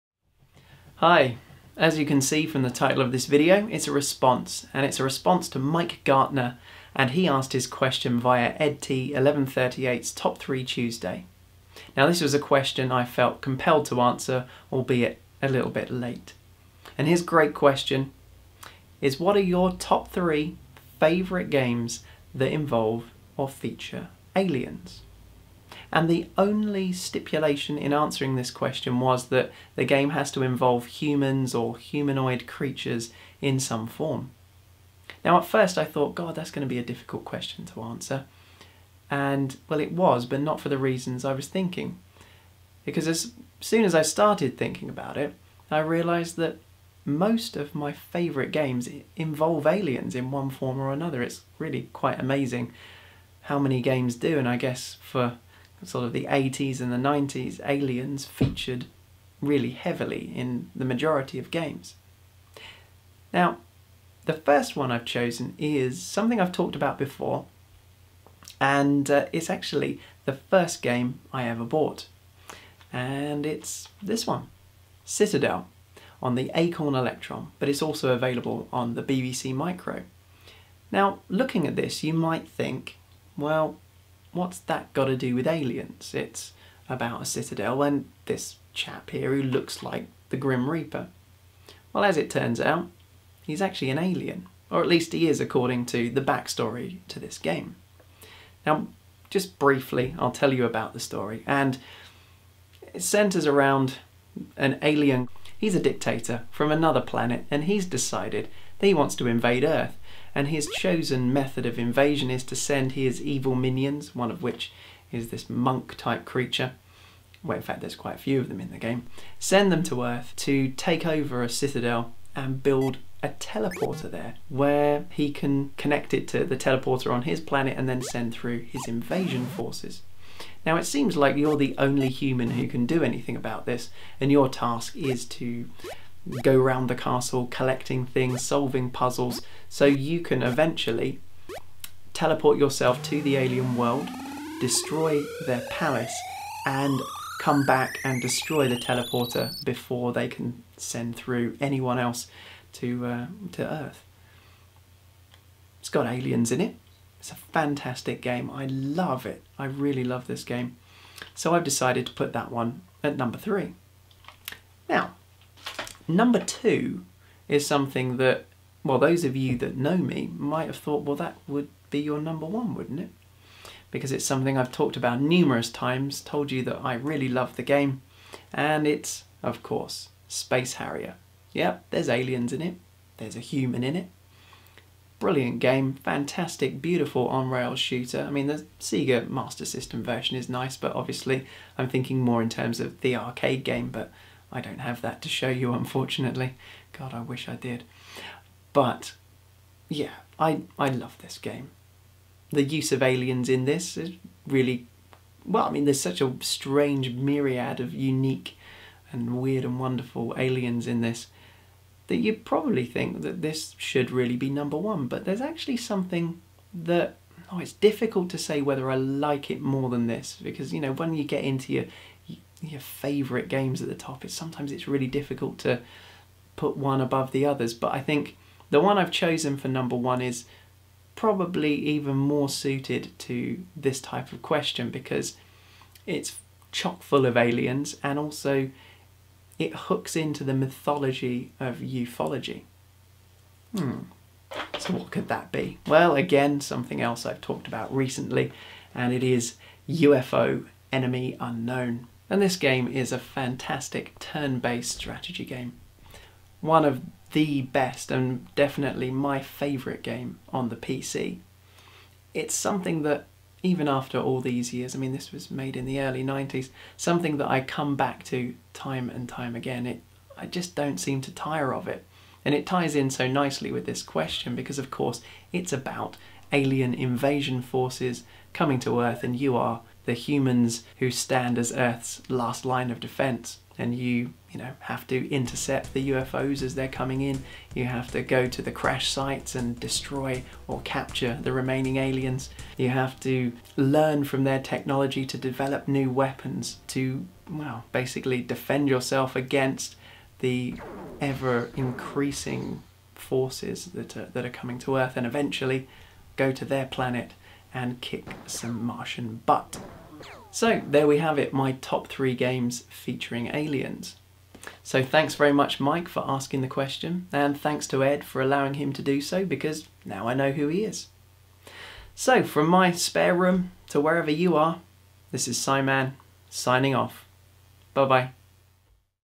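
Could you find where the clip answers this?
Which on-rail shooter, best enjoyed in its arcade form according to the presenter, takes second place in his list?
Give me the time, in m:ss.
3:00.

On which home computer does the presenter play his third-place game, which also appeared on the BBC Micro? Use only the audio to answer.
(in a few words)
Acorn Electron.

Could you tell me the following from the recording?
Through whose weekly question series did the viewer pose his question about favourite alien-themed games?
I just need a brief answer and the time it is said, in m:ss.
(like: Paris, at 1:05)
EdT1138's Top 3 Tuesday, at 0:08.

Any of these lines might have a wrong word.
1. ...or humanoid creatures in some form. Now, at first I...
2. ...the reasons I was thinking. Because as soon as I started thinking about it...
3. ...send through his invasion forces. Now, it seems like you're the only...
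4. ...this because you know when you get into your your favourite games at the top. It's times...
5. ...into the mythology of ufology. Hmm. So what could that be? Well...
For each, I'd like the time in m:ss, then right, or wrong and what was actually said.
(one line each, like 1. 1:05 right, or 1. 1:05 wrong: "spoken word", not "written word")
1. 0:31 right
2. 0:40 right
3. 2:08 right
4. 3:40 wrong: "sometimes", not "times"
5. 4:00 right.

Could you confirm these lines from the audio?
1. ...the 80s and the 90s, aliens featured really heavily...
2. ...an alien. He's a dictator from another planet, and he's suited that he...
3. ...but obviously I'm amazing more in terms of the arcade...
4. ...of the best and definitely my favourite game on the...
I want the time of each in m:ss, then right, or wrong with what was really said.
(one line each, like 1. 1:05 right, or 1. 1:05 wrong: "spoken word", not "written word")
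1. 0:56 right
2. 1:44 wrong: "decided", not "suited"
3. 3:10 wrong: "thinking", not "amazing"
4. 4:16 right.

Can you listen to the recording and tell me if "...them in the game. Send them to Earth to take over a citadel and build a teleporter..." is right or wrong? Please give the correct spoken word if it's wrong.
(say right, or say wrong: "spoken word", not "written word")
right.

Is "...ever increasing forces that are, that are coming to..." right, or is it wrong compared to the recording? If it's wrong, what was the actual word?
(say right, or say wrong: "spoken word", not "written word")
right.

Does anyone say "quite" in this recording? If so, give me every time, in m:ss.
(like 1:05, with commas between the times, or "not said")
0:51, 1:57.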